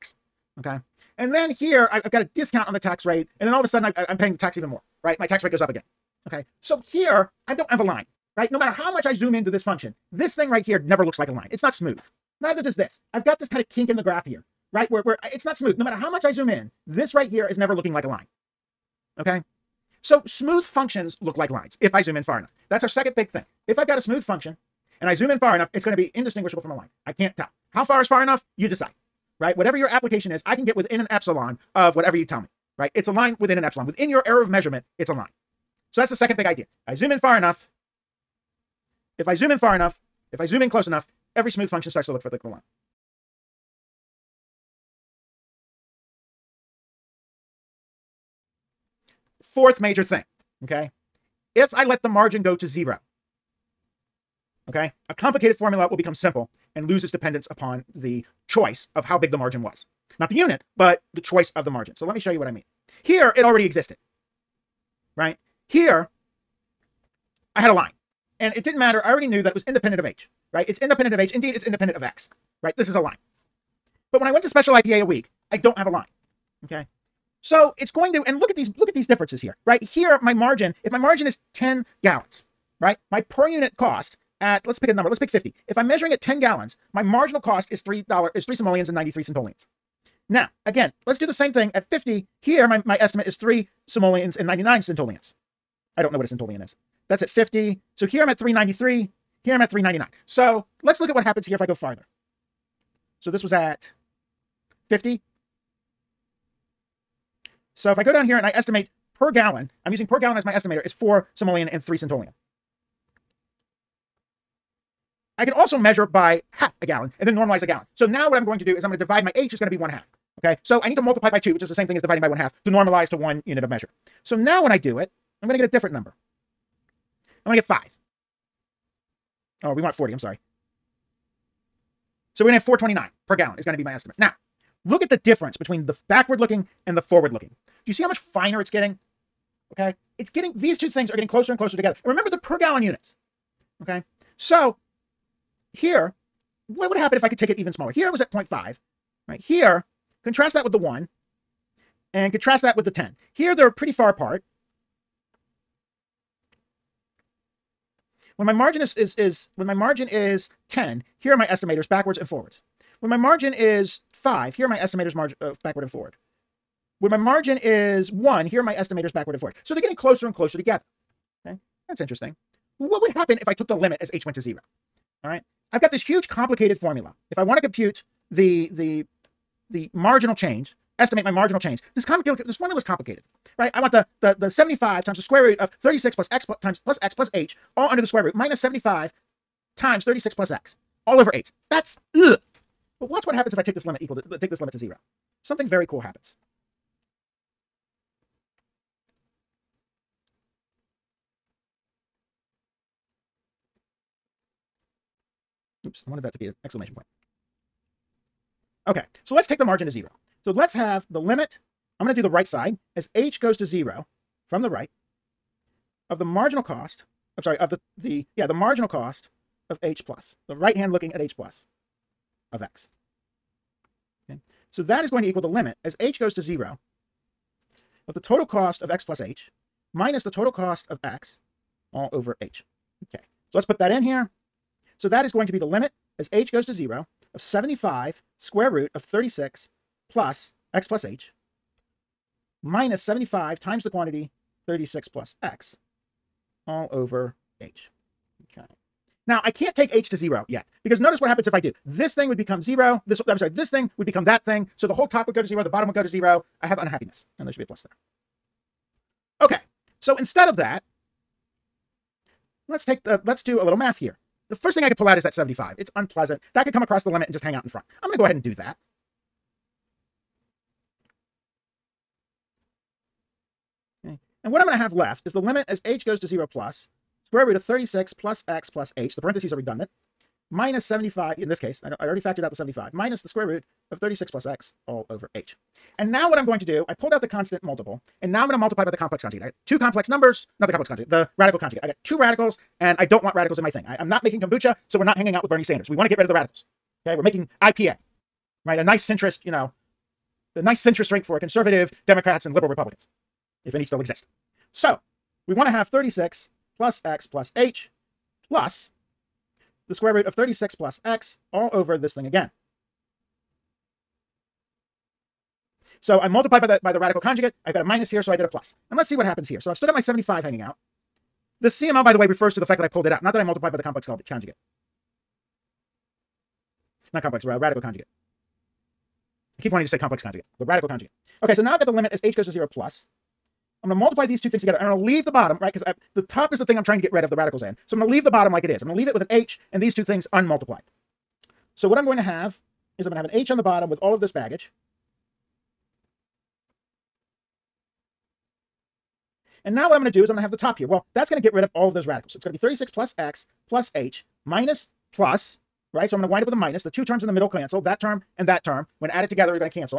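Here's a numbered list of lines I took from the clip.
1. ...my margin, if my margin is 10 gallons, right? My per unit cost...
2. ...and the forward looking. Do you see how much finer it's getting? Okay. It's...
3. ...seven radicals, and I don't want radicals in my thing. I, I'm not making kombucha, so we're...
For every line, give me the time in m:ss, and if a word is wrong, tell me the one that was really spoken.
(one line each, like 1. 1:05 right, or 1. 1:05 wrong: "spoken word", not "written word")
1. 1:20 right
2. 2:16 right
3. 4:52 wrong: "two", not "seven".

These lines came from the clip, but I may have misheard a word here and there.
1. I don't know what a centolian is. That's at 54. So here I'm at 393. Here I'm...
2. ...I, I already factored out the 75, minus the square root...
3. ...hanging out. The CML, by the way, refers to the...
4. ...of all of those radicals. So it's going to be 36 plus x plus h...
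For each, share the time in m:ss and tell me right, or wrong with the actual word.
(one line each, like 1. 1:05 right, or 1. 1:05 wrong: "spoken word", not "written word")
1. 1:35 wrong: "50", not "54"
2. 4:41 right
3. 5:20 right
4. 5:51 right.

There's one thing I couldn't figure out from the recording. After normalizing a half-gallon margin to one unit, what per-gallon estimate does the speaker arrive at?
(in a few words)
429.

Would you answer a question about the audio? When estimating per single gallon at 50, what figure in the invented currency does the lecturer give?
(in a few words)
4 simoleons and 3 centolians.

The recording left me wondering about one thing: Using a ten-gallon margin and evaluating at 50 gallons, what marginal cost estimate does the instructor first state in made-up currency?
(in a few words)
3 simoleons and 93 centolians.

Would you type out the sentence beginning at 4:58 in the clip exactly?
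A nice centrist, you know, the nice centrist drink for conservative Democrats and liberal Republicans, if any still exist.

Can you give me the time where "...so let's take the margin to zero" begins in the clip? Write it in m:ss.
3:29.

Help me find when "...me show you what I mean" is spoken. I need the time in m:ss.
1:02.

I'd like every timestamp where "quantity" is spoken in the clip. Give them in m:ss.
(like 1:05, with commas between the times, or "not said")
4:03.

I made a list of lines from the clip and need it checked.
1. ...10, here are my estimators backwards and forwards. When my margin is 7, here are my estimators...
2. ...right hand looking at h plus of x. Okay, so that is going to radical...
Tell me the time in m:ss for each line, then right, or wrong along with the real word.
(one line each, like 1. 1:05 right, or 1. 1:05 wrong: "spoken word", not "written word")
1. 2:40 wrong: "5", not "7"
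2. 3:40 wrong: "equal", not "radical".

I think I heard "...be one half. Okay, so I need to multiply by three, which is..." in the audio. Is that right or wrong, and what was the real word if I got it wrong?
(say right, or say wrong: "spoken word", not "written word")
wrong: "two", not "three".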